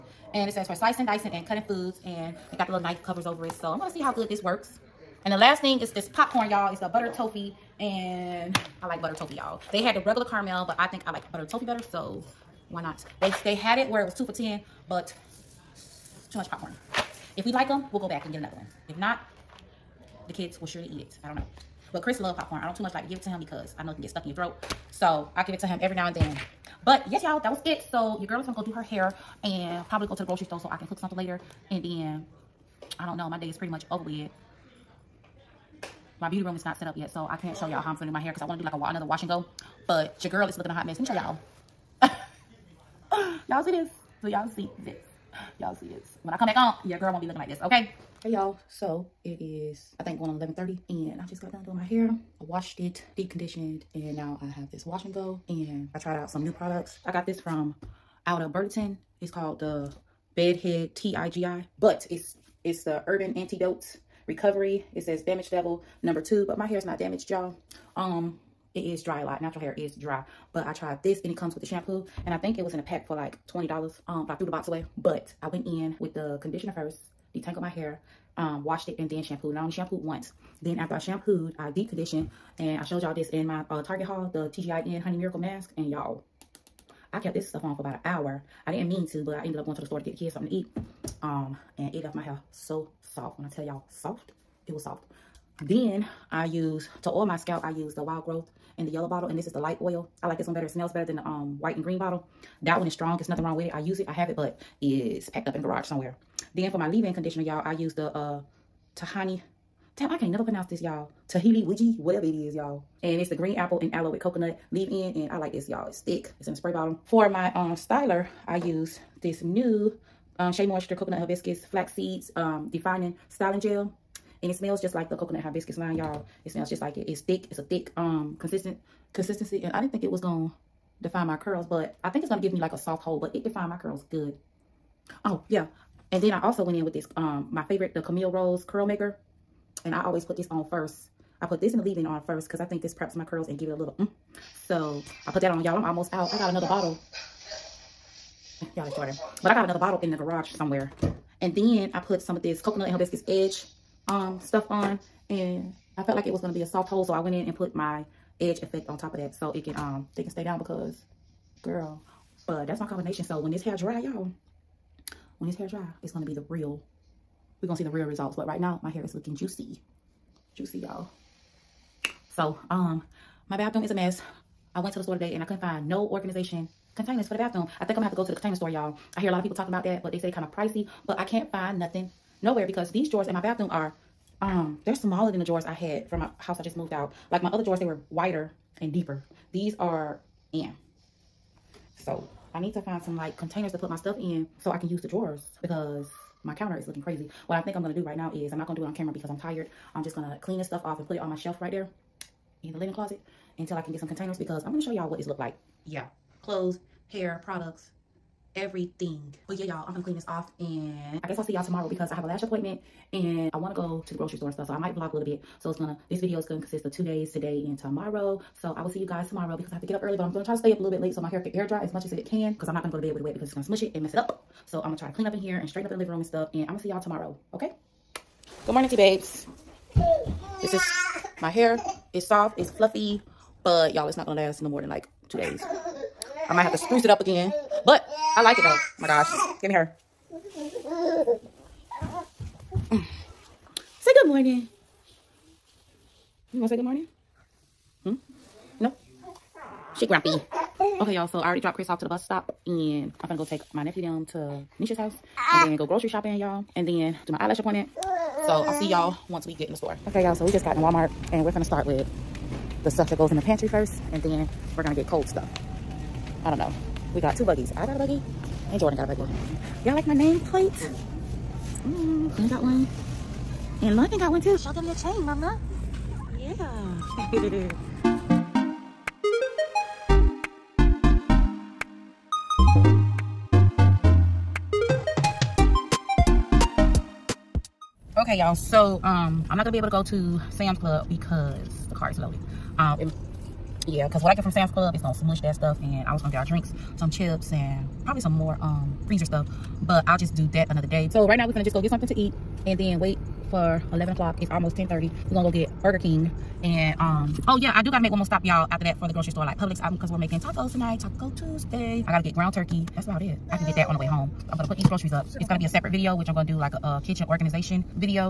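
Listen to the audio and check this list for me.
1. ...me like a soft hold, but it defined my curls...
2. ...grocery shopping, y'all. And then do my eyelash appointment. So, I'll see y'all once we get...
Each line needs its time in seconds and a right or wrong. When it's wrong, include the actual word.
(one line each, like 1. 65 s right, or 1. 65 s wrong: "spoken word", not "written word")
1. 132 s right
2. 255 s right.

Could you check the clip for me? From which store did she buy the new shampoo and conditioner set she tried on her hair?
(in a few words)
Burlington.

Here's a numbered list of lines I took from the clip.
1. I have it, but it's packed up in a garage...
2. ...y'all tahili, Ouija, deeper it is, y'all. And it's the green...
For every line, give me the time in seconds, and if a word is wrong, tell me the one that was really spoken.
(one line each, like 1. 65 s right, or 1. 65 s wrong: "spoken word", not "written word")
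1. 104 s right
2. 110 s wrong: "whatever", not "deeper".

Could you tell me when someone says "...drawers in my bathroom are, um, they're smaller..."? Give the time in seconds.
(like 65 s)
183 s.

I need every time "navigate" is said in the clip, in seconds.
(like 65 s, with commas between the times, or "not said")
not said.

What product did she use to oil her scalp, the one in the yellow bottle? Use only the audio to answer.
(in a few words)
Wild Growth.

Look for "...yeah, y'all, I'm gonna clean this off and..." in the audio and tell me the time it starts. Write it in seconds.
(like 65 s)
209 s.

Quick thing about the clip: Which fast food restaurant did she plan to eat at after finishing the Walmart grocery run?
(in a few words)
Burger King.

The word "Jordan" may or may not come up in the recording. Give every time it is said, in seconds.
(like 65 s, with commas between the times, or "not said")
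148 s, 268 s.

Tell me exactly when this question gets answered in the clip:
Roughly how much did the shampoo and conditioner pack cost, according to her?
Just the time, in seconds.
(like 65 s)
73 s.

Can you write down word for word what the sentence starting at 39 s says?
But your girl is looking a hot mess.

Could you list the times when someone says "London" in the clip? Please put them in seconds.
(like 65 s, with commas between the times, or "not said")
273 s.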